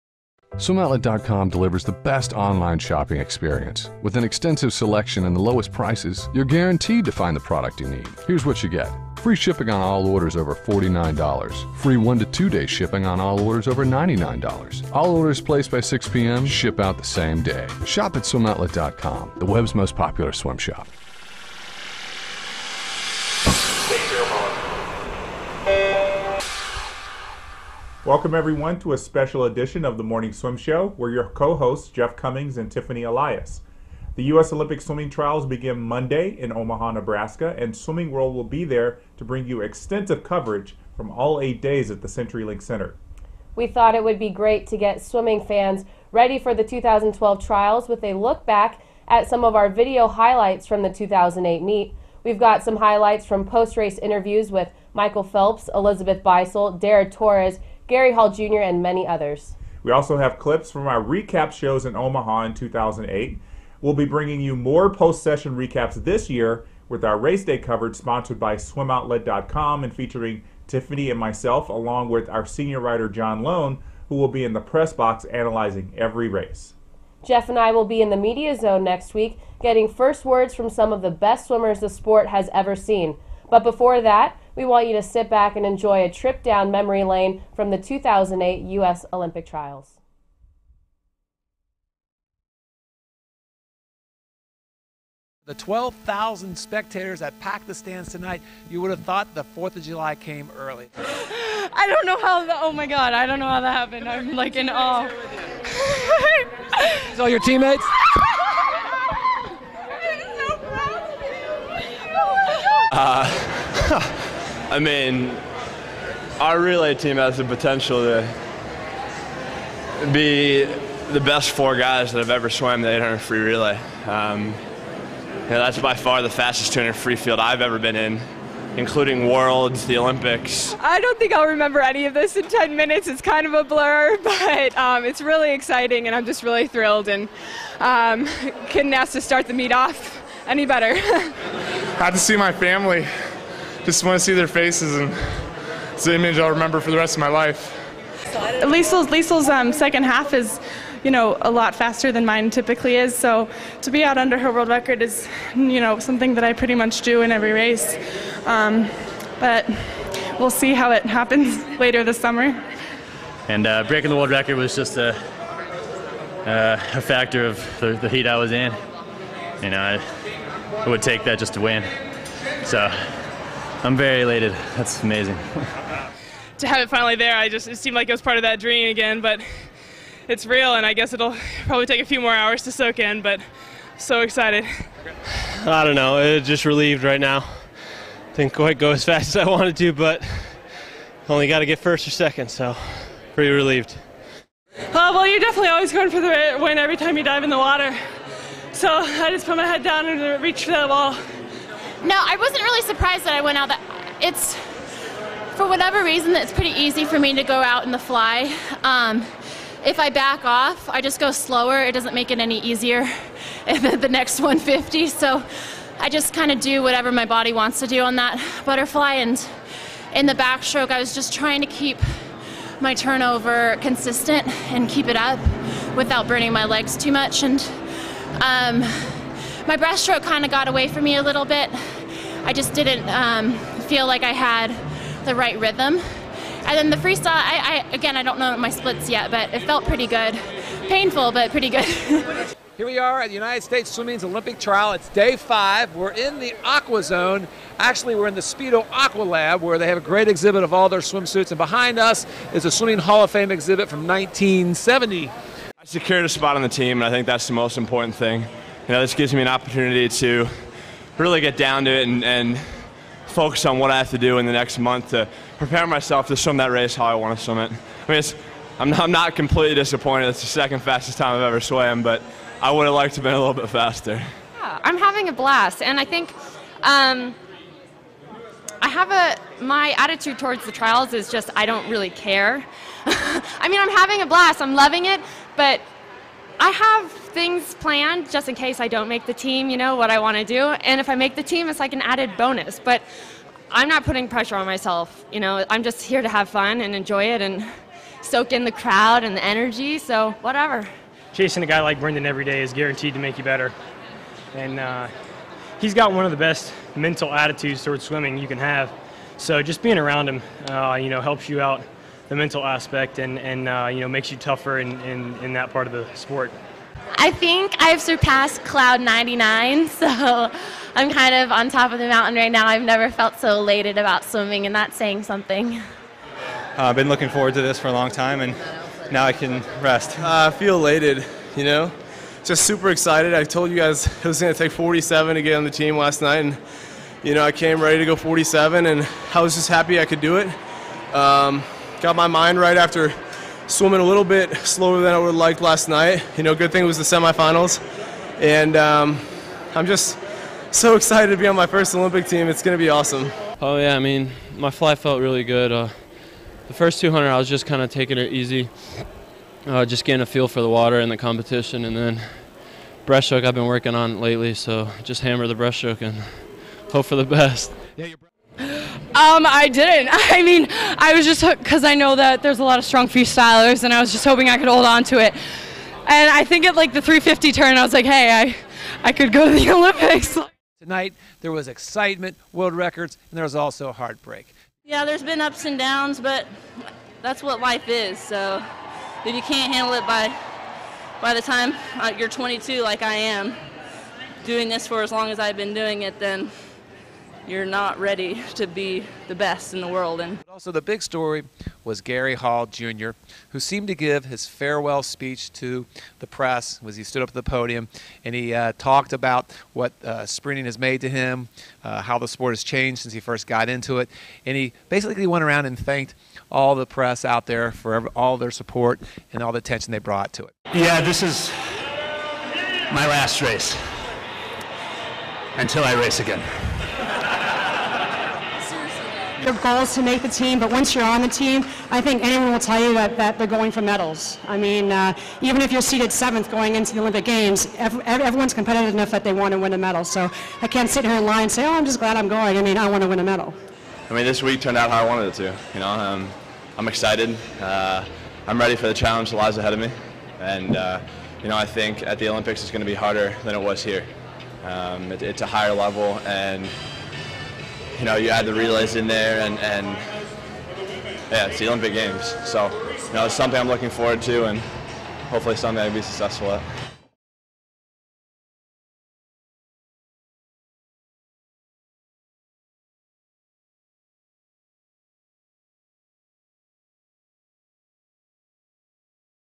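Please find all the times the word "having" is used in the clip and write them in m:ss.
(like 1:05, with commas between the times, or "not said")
4:34, 4:43.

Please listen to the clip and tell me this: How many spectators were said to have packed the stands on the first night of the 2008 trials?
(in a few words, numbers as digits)
12,000.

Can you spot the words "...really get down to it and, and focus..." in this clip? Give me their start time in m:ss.
4:21.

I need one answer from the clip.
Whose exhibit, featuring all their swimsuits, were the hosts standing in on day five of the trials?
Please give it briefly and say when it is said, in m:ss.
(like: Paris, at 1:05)
Speedo, at 4:08.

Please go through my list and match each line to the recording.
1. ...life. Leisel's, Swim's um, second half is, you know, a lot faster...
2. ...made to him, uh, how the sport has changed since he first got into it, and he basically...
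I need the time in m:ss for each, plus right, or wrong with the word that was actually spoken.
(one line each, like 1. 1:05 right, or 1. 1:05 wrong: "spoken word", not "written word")
1. 2:27 wrong: "Leisel", not "Swim"
2. 6:50 right.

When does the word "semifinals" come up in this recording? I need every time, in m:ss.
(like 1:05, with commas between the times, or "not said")
5:47.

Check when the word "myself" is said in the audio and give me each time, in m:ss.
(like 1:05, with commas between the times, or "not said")
1:11, 4:25, 4:54.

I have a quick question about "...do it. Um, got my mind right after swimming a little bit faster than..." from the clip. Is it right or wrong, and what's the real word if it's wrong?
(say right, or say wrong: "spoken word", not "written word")
wrong: "slower", not "faster".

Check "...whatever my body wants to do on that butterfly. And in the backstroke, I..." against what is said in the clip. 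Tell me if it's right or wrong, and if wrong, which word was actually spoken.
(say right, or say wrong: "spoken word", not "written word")
right.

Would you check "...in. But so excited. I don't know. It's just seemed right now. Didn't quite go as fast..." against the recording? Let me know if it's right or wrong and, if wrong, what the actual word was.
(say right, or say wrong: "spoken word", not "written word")
wrong: "relieved", not "seemed".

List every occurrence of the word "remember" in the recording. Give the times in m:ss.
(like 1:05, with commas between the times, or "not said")
2:11, 2:26.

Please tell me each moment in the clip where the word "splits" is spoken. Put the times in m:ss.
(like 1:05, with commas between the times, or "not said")
3:58.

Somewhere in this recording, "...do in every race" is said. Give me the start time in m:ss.
2:37.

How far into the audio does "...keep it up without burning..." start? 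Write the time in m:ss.
3:44.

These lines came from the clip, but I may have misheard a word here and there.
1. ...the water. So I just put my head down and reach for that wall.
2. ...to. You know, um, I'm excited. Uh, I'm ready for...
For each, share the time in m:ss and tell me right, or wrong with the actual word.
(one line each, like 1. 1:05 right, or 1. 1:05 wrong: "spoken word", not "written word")
1. 3:17 right
2. 7:25 right.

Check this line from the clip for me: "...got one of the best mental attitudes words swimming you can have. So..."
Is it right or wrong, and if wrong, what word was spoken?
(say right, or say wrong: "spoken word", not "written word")
wrong: "towards", not "words".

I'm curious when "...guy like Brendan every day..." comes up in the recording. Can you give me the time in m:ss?
5:01.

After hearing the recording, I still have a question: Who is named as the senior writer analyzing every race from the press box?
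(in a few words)
John Lohn.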